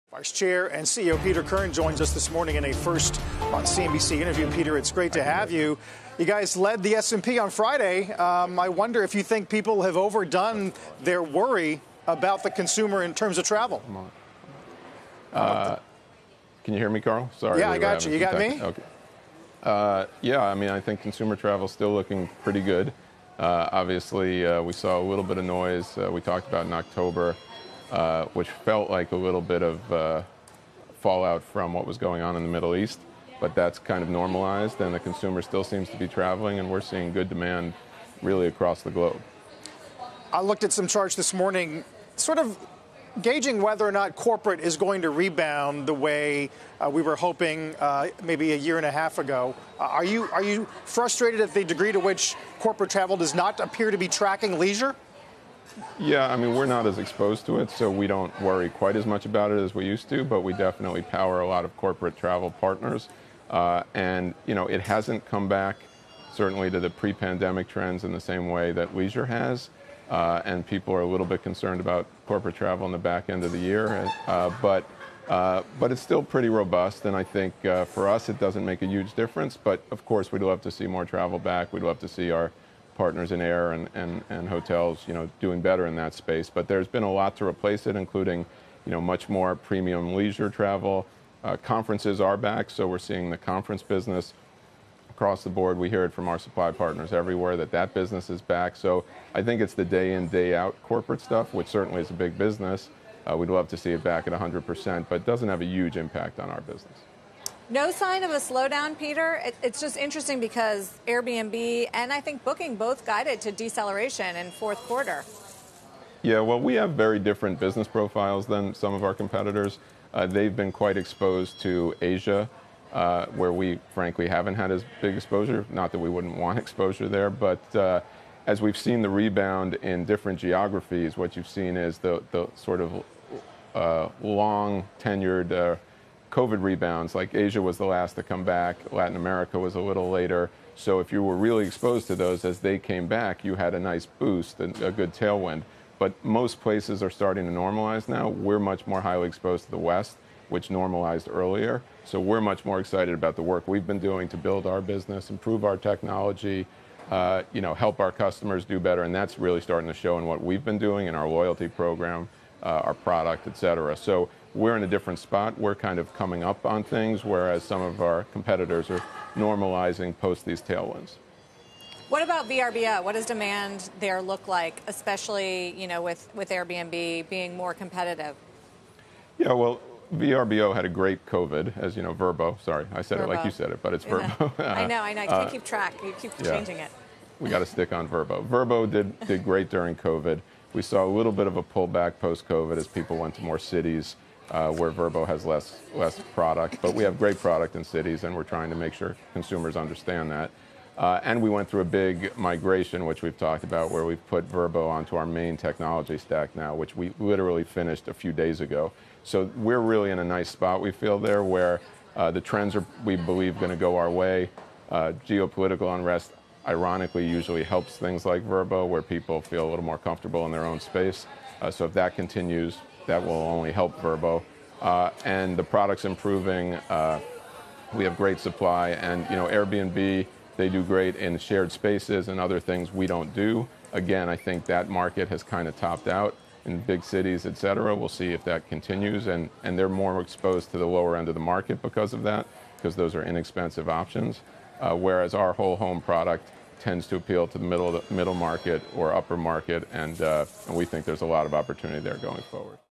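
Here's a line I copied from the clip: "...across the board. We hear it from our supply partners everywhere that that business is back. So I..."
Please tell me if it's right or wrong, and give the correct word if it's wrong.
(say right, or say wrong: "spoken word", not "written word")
right.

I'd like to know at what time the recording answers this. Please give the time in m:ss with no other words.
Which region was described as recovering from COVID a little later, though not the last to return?
2:18.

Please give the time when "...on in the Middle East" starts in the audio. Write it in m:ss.
0:32.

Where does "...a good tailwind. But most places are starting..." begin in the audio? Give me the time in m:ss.
2:24.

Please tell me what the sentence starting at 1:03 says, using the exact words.
Uh, and, you know, it hasn't come back certainly to the pre pandemic trends in the same way that leisure has.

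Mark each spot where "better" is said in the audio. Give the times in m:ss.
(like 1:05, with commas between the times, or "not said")
1:25, 2:38.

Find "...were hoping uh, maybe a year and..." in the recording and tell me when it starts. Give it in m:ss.
0:47.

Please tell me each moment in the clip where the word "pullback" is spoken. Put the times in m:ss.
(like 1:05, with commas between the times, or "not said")
3:11.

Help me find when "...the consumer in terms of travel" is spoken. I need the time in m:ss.
0:12.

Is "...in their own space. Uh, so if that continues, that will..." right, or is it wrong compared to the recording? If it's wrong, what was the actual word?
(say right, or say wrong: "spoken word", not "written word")
right.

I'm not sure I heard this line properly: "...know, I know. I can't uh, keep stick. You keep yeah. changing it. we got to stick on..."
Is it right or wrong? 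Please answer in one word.
wrong.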